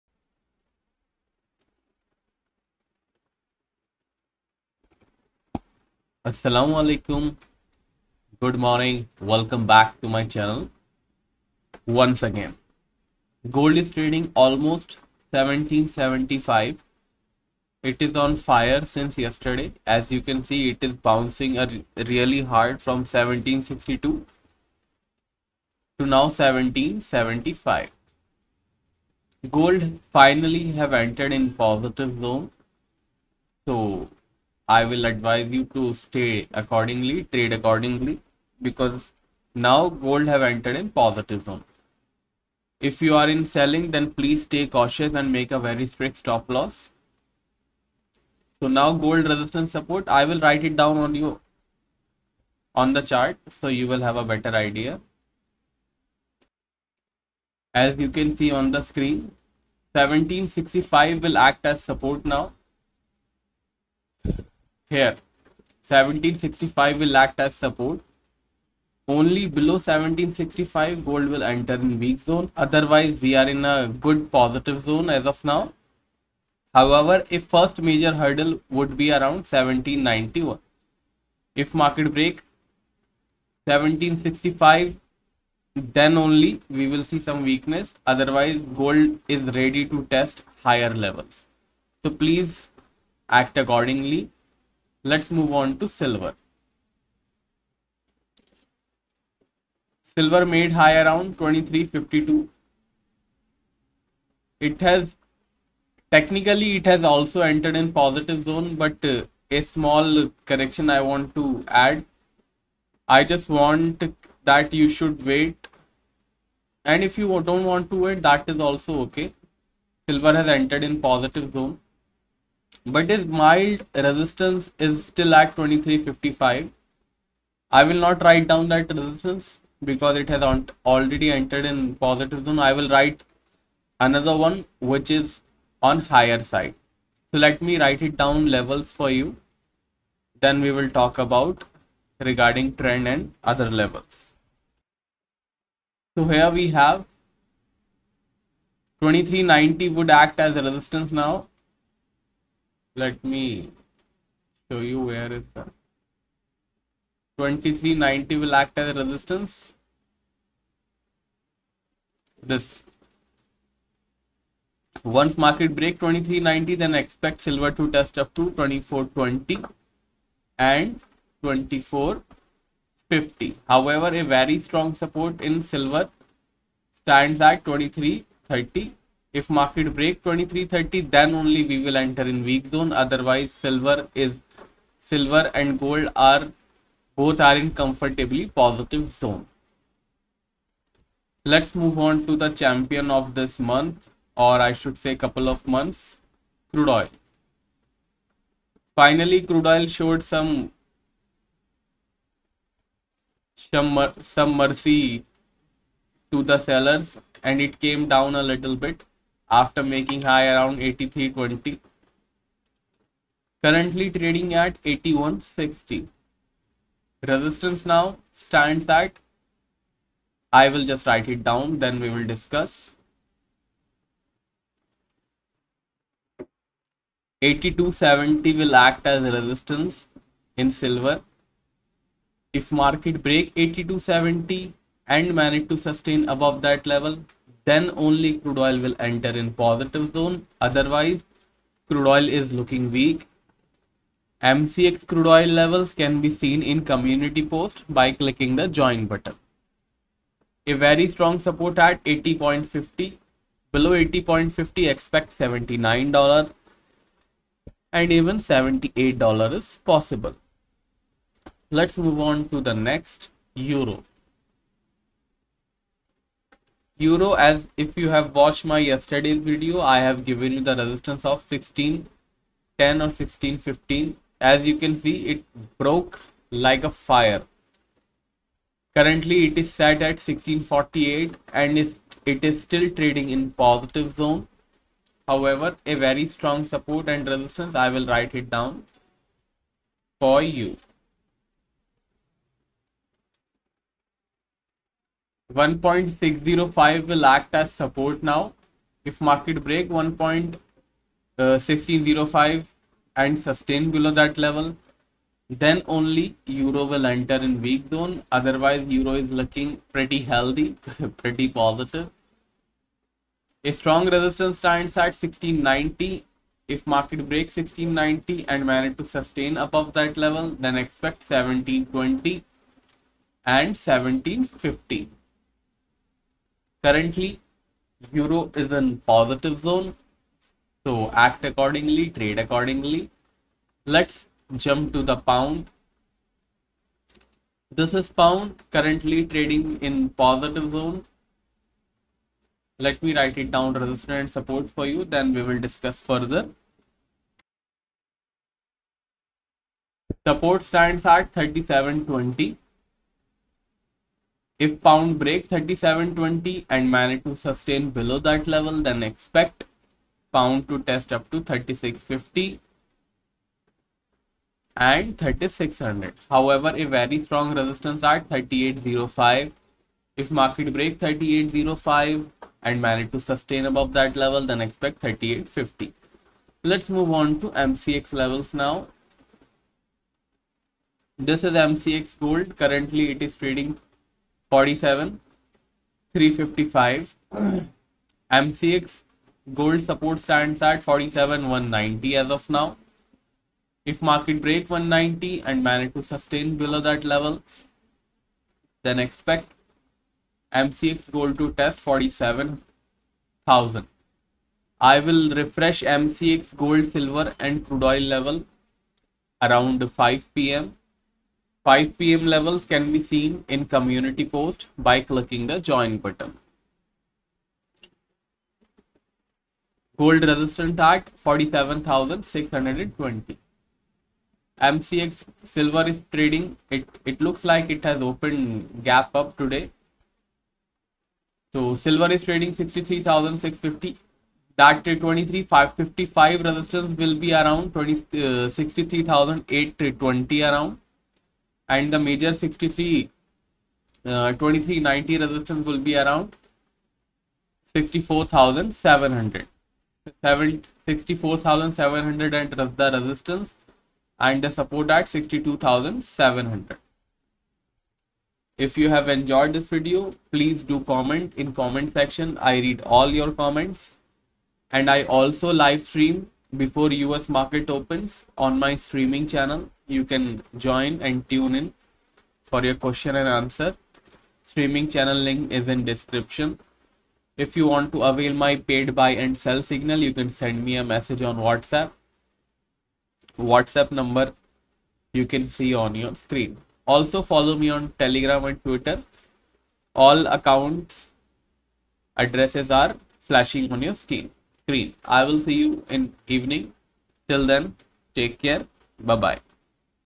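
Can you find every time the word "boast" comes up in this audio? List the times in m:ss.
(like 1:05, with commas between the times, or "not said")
not said.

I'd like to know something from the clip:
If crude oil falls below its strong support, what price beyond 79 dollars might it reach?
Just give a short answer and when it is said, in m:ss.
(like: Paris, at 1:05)
78 dollars, at 4:18.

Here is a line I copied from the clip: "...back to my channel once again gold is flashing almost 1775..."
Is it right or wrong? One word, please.
wrong.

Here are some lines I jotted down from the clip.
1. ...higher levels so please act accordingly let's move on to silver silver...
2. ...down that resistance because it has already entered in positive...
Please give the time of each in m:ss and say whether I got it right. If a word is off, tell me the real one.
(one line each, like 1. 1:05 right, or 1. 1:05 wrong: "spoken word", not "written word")
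1. 1:30 right
2. 2:08 right.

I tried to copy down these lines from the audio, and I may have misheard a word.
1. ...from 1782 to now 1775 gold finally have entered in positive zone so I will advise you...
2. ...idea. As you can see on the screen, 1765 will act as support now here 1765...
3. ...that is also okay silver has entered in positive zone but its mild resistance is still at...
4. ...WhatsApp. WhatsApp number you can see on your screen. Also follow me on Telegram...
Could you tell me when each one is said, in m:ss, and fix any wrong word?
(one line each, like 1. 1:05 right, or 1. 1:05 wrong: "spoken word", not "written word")
1. 0:22 wrong: "1762", not "1782"
2. 0:54 right
3. 1:58 right
4. 8:01 right.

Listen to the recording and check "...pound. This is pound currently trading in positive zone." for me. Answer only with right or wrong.
right.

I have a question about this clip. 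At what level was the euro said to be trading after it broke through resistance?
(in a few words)
1648.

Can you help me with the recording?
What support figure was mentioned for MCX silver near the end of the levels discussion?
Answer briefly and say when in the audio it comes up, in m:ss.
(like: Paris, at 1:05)
62,700, at 7:35.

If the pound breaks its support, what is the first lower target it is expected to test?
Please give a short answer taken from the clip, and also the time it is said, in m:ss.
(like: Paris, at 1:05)
36.50, at 6:01.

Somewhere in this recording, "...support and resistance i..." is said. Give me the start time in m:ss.
4:46.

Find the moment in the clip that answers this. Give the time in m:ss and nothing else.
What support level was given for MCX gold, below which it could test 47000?
6:30.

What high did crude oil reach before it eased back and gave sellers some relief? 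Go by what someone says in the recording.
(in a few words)
83.20.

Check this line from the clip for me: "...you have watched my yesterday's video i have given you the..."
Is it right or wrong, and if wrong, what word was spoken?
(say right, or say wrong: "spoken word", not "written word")
right.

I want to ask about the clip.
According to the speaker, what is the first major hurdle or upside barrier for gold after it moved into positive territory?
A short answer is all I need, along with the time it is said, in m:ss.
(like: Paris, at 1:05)
1791, at 1:19.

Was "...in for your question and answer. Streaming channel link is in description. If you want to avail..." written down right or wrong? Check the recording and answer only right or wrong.
right.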